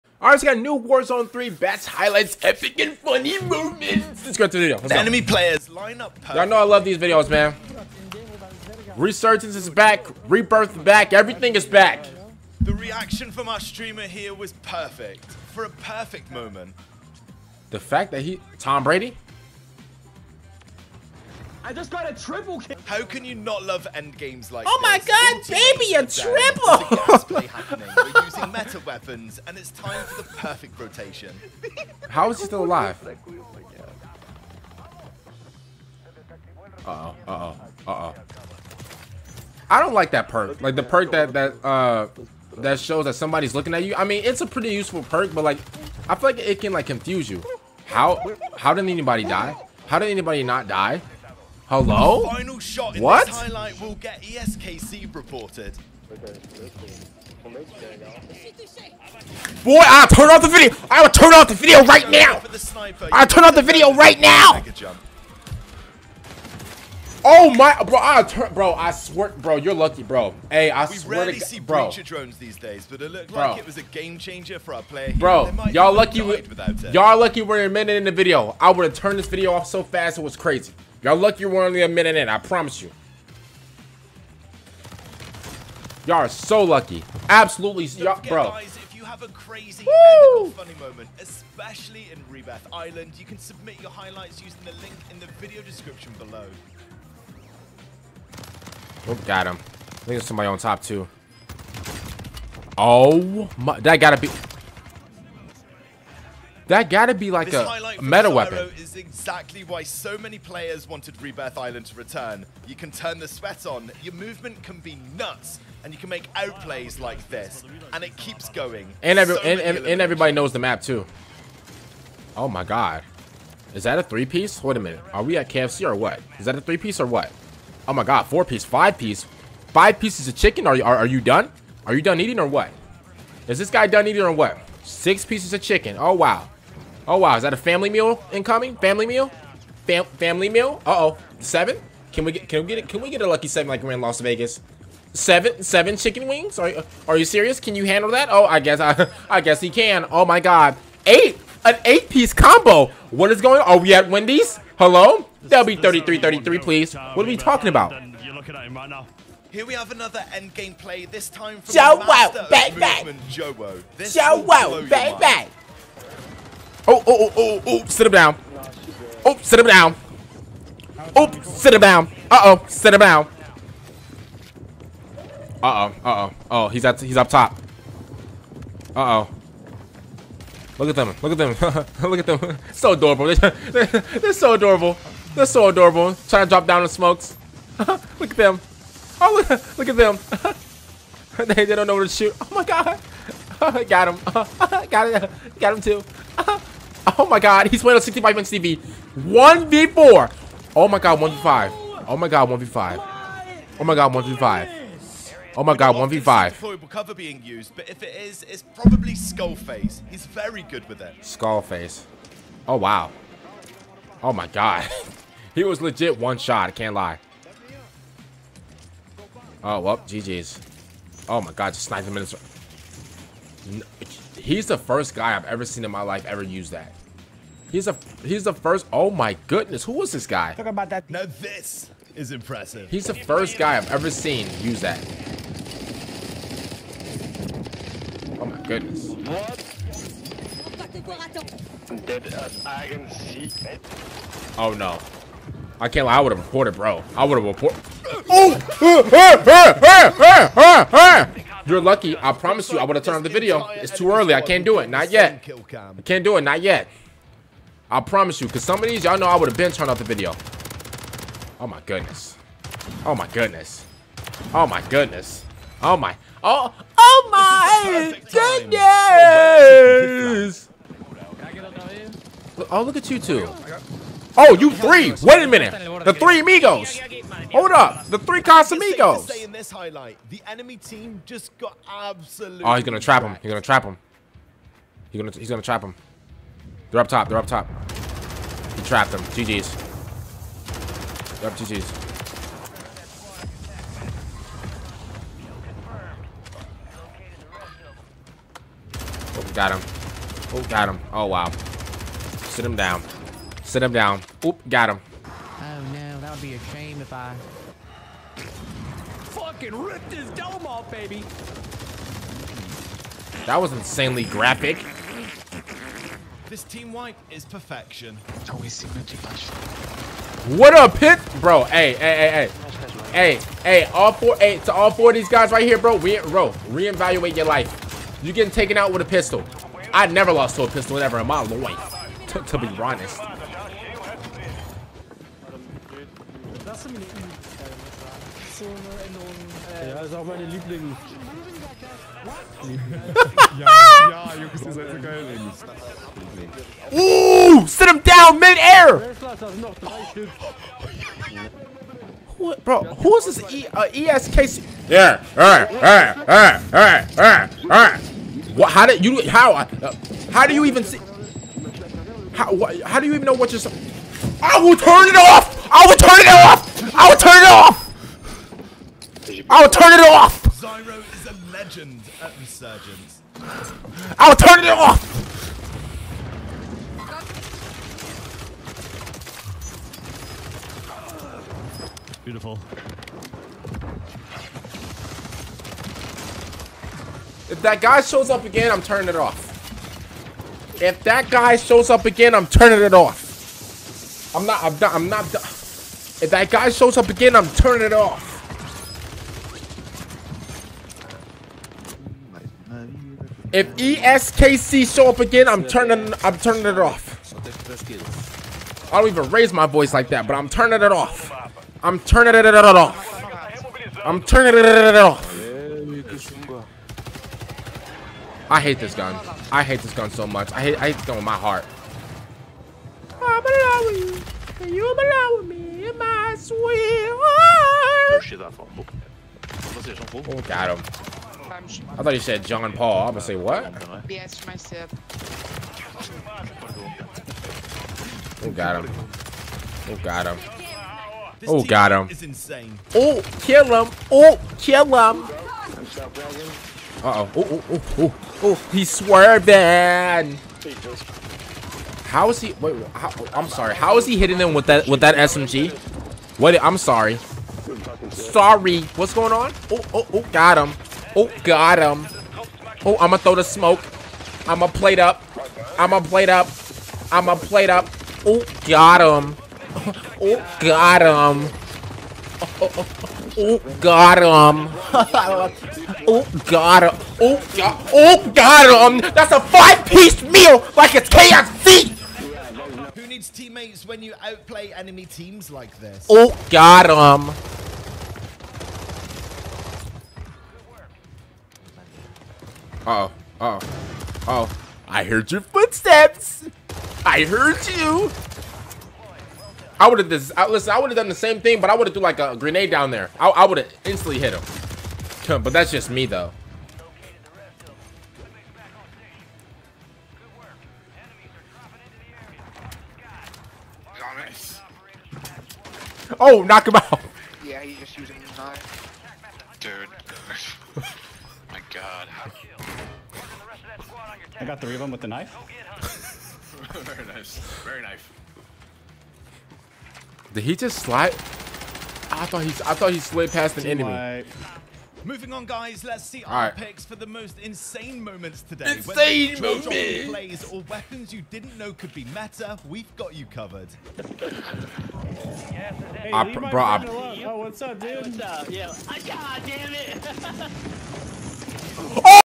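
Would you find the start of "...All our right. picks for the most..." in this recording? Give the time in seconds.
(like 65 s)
536 s.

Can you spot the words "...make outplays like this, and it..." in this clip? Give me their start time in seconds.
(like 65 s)
116 s.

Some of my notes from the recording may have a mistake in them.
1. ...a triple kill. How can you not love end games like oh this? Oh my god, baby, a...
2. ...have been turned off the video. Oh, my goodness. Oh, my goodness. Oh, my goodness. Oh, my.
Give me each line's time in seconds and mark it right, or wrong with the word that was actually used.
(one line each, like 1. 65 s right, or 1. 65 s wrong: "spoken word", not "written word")
1. 22 s right
2. 259 s right.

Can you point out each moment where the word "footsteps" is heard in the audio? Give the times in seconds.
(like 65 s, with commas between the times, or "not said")
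495 s.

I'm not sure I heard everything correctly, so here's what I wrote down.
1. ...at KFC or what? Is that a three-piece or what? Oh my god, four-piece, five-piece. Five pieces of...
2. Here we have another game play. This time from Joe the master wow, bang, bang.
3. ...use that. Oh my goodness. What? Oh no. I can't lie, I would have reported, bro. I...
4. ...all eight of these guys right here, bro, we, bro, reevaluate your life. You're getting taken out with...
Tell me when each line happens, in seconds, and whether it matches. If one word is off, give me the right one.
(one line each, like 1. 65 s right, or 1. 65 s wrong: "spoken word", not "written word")
1. 125 s right
2. 159 s right
3. 234 s right
4. 324 s wrong: "four", not "eight".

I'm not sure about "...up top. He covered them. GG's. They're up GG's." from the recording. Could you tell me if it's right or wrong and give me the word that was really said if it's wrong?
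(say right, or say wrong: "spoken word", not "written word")
wrong: "trapped", not "covered".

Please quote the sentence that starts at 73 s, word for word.
like it was a game changer for our player.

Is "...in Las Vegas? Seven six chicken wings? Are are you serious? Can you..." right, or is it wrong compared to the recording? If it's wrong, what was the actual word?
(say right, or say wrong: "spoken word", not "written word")
wrong: "seven", not "six".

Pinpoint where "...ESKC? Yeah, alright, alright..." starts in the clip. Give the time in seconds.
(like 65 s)
354 s.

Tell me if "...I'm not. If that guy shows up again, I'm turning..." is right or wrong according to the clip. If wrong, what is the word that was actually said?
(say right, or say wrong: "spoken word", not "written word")
right.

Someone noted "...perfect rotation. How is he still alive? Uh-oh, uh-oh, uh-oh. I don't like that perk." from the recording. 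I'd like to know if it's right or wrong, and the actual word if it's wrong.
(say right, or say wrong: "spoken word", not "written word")
right.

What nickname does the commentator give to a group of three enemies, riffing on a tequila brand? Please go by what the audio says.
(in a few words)
The three Casamigos.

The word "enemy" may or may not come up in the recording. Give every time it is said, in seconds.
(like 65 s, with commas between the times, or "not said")
4 s, 280 s, 484 s, 533 s.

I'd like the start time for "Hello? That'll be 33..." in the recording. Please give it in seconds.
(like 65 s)
154 s.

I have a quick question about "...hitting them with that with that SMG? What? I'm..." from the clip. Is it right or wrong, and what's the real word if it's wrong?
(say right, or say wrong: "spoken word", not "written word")
right.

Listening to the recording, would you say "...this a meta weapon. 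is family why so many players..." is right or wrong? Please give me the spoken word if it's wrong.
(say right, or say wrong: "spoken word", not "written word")
wrong: "exactly", not "family".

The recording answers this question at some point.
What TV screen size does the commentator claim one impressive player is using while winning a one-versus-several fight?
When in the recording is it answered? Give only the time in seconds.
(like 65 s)
198 s.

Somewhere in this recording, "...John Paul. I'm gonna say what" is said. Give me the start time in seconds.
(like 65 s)
432 s.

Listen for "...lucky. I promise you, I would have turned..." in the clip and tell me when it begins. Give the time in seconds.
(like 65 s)
251 s.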